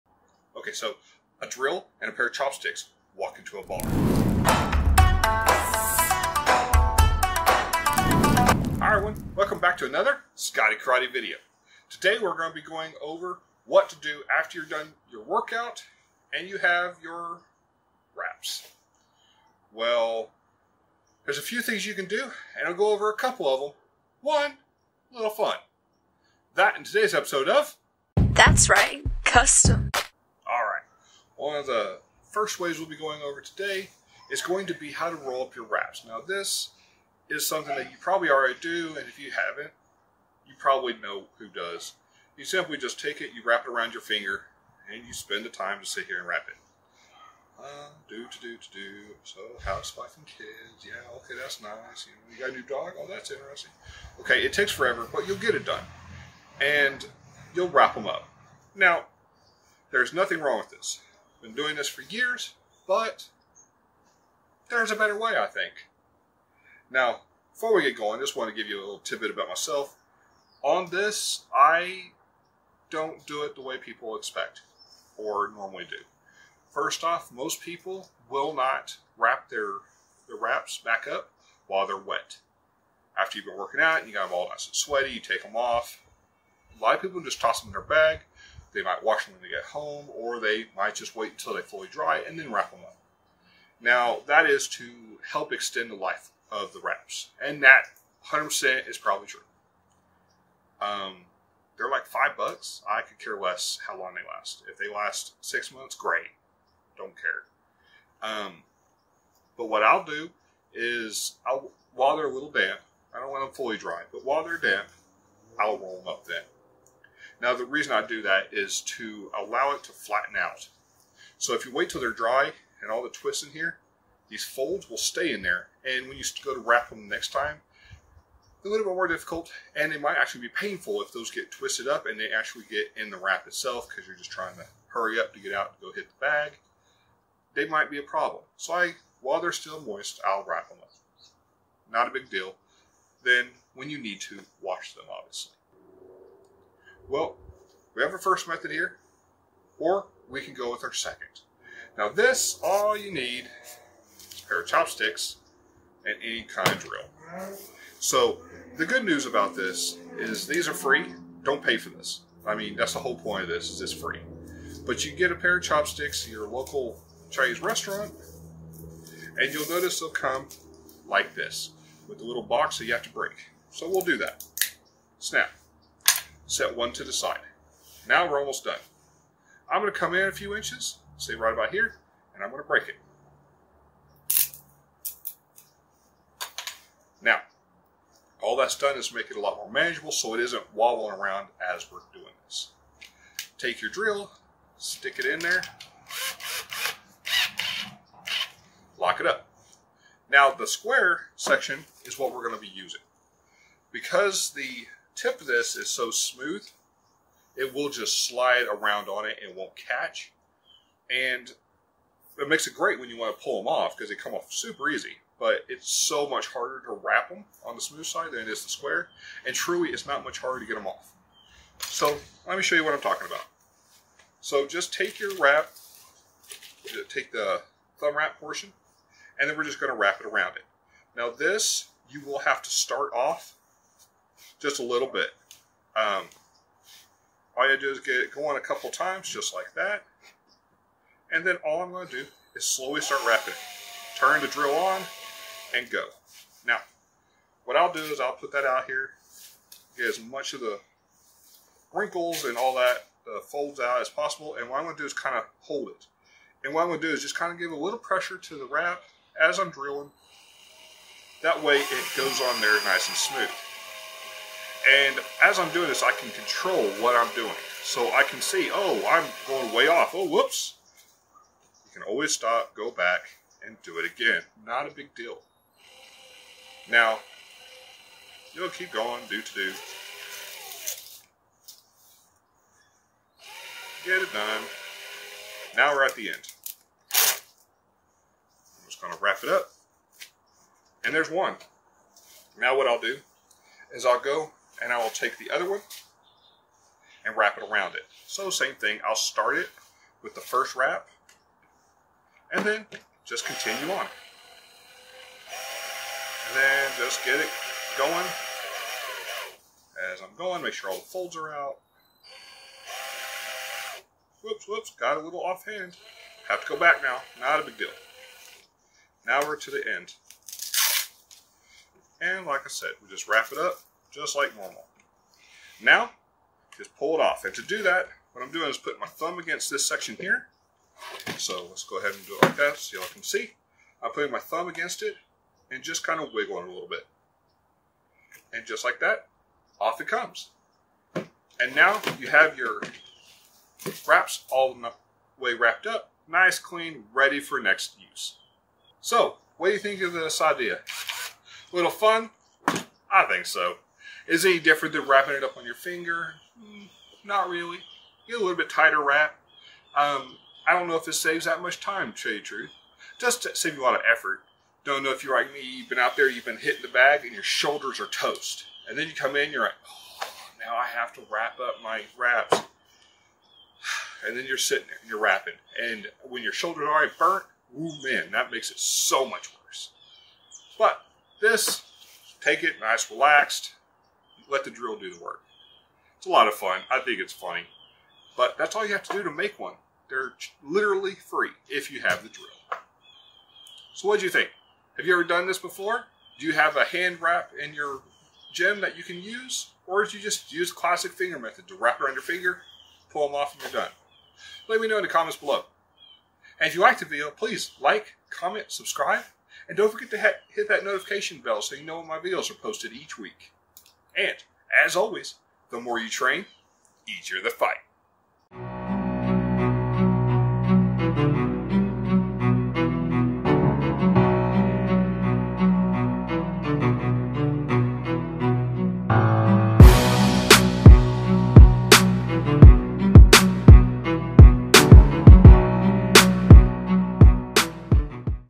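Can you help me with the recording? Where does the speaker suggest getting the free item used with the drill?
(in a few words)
Chinese restaurant.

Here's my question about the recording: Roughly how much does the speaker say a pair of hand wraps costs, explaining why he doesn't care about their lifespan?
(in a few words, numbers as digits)
5 bucks.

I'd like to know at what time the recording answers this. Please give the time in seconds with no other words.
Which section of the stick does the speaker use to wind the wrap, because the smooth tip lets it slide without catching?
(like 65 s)
200 s.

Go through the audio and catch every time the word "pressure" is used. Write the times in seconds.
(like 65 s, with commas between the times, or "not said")
257 s.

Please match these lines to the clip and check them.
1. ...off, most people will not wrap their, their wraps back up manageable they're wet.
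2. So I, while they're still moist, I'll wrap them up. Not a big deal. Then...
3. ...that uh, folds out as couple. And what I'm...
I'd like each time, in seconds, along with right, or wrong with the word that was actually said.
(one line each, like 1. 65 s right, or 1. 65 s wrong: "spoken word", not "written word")
1. 77 s wrong: "while", not "manageable"
2. 138 s right
3. 252 s wrong: "possible", not "couple".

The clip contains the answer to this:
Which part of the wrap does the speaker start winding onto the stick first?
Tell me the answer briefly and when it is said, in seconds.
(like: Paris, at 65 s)
the thumb wrap portion, at 227 s.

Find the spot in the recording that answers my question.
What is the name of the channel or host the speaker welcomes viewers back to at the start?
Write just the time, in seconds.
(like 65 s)
10 s.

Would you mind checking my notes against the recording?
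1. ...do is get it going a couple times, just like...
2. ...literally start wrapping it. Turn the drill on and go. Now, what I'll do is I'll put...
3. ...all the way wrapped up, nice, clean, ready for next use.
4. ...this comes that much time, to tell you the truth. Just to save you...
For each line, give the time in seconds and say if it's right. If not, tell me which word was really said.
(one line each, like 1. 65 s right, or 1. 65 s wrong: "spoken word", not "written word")
1. 237 s right
2. 242 s wrong: "slowly", not "literally"
3. 344 s right
4. 361 s wrong: "saves", not "comes".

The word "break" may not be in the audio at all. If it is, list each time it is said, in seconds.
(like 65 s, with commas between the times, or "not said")
173 s, 182 s.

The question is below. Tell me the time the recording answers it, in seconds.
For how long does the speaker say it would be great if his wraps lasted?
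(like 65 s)
105 s.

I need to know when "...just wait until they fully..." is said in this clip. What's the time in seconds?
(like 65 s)
90 s.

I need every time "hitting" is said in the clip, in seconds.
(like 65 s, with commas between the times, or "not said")
366 s.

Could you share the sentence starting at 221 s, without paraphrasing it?
So let me show you what I'm talking about.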